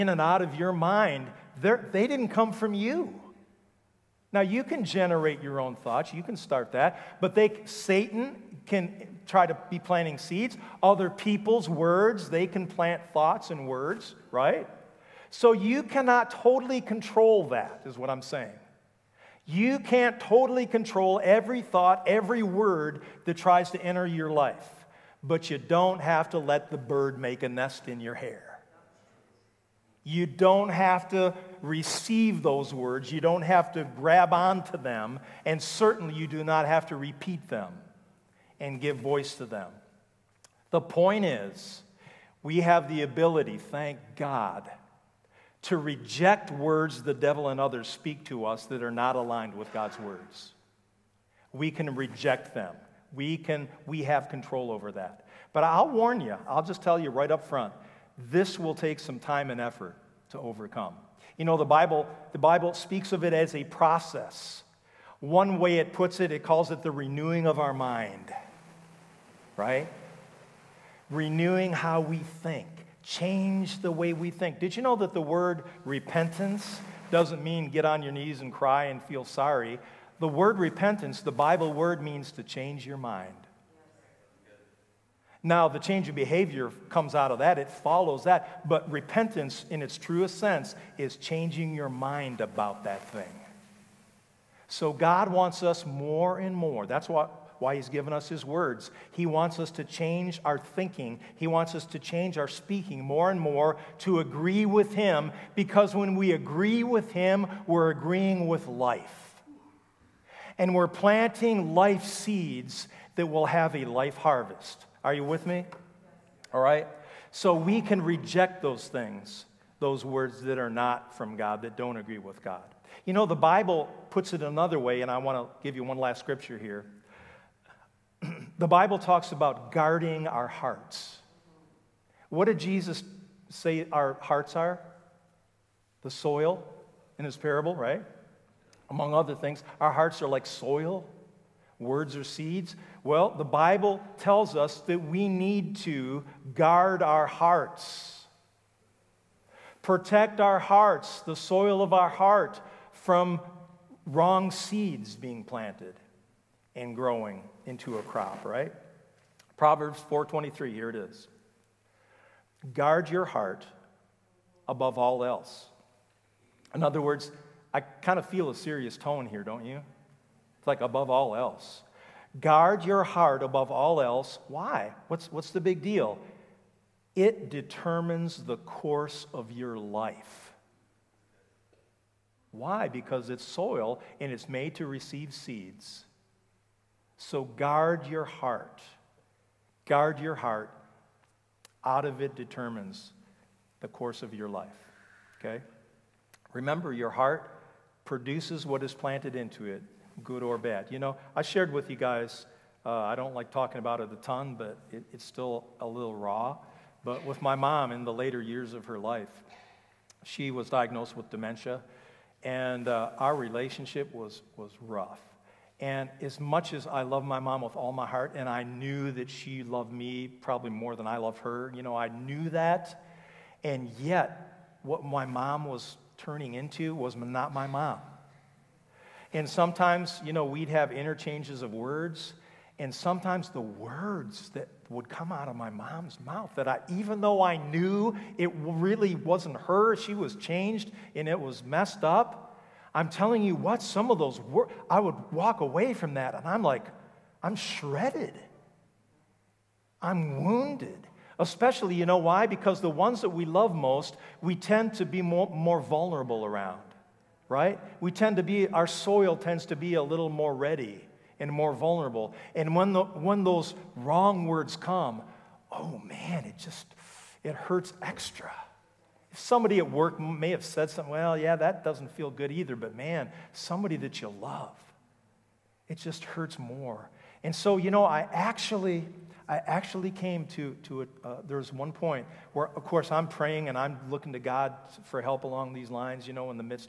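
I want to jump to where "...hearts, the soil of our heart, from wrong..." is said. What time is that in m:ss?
2:30.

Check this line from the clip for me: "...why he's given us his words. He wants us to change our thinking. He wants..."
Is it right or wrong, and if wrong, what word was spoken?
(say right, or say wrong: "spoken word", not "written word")
right.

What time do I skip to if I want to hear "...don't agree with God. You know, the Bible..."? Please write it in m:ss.
2:01.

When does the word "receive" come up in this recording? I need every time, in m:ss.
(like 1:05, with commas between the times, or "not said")
0:31, 3:04.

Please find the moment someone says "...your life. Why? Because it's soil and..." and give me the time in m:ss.
2:59.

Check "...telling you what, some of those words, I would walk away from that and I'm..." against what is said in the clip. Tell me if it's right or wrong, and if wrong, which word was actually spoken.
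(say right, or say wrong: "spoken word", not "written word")
right.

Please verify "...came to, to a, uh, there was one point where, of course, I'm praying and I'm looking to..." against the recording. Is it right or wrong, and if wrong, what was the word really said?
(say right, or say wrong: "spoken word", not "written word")
right.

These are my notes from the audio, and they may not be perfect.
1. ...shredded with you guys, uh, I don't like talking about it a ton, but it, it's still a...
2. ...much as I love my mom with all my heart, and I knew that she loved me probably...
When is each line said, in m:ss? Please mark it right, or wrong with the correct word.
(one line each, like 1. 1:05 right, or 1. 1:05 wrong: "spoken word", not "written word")
1. 3:21 wrong: "shared", not "shredded"
2. 3:36 right.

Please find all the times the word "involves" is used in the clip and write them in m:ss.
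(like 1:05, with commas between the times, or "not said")
not said.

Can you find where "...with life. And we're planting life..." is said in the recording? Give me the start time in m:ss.
1:48.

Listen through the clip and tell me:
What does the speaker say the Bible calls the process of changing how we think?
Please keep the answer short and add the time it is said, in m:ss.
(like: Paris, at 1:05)
renewing of our mind, at 1:06.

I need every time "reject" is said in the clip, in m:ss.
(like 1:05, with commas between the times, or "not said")
0:45, 0:51, 1:58.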